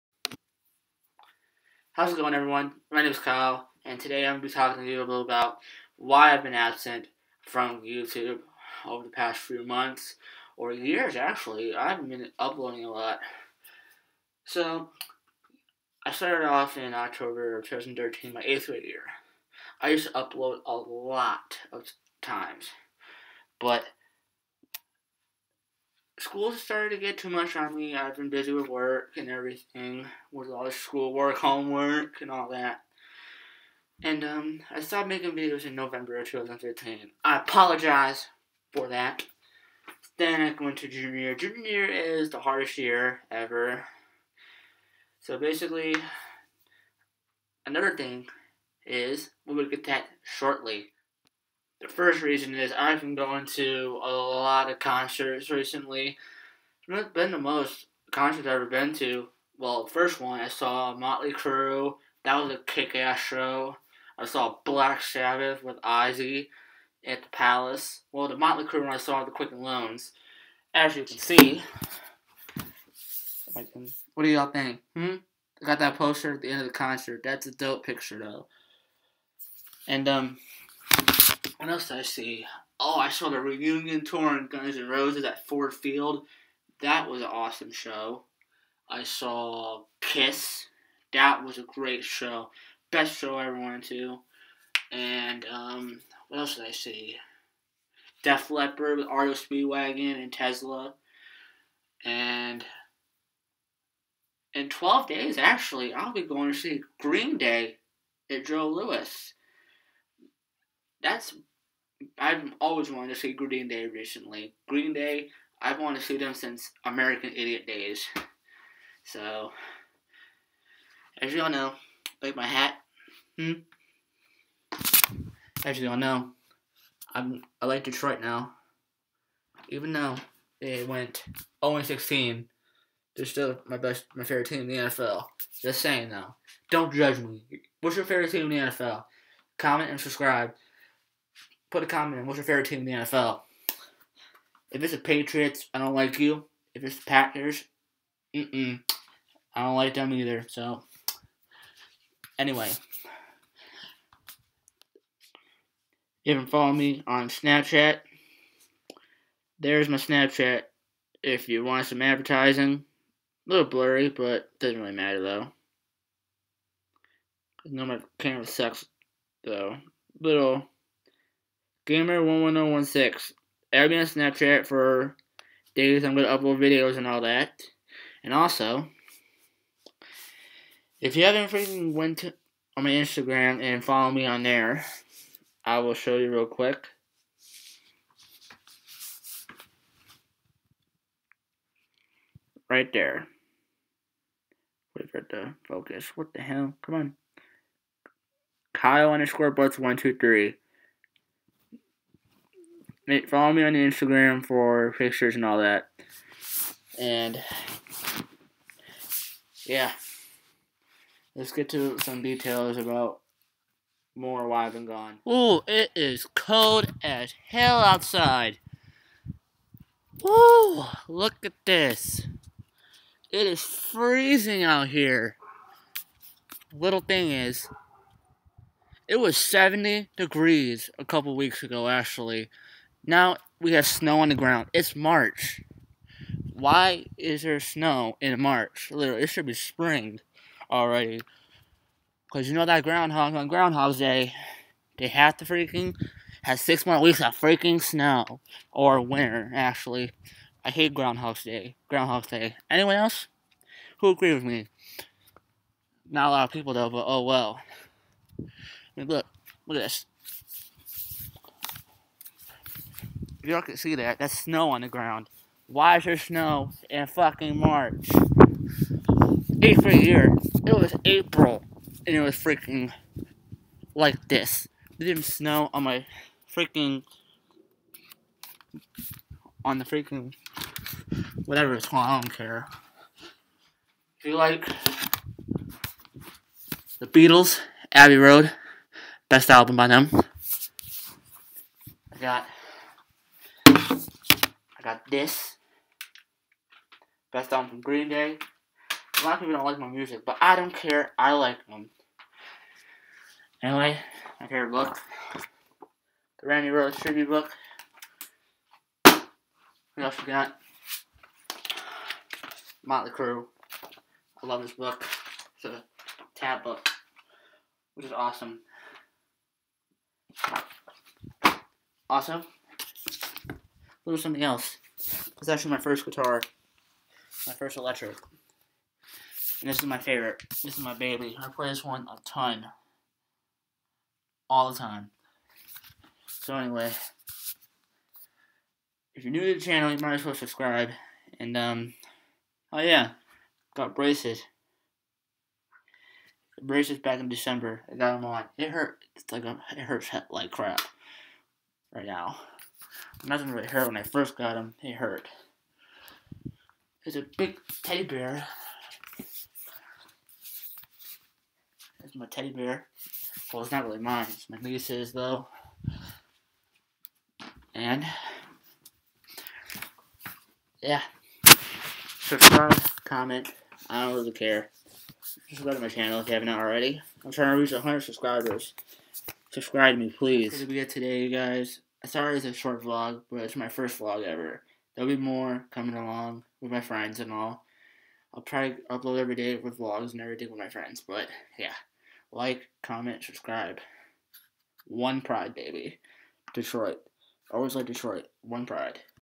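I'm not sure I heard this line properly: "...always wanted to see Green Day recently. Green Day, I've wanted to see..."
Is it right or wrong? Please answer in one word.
right.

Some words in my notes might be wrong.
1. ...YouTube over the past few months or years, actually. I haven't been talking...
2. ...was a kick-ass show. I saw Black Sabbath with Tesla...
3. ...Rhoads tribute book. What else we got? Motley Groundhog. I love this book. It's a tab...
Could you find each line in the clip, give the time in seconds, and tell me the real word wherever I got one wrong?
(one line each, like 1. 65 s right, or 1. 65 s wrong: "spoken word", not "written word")
1. 7 s wrong: "uploading", not "talking"
2. 62 s wrong: "Ozzy", not "Tesla"
3. 306 s wrong: "Crue", not "Groundhog".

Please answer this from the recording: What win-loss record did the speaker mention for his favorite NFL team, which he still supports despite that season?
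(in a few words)
0-16.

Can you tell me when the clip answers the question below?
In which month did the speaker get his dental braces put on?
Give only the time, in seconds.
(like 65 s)
347 s.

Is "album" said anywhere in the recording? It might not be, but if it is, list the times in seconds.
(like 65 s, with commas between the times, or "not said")
289 s, 297 s.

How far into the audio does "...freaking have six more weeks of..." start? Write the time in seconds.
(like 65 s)
245 s.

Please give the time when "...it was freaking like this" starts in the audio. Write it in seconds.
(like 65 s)
272 s.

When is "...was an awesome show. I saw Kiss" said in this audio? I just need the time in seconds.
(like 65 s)
87 s.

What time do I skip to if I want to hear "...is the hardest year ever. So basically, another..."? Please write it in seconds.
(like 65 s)
41 s.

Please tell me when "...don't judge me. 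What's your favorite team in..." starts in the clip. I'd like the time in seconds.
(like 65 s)
136 s.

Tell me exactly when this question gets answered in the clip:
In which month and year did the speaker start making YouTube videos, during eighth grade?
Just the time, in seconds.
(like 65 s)
16 s.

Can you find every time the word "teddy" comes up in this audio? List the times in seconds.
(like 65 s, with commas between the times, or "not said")
357 s, 362 s.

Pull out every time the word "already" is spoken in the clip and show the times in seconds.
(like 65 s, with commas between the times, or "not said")
240 s, 376 s.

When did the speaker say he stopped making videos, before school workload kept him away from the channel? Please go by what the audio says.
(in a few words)
November 2015.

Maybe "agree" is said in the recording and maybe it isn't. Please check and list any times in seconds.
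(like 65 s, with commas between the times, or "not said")
254 s.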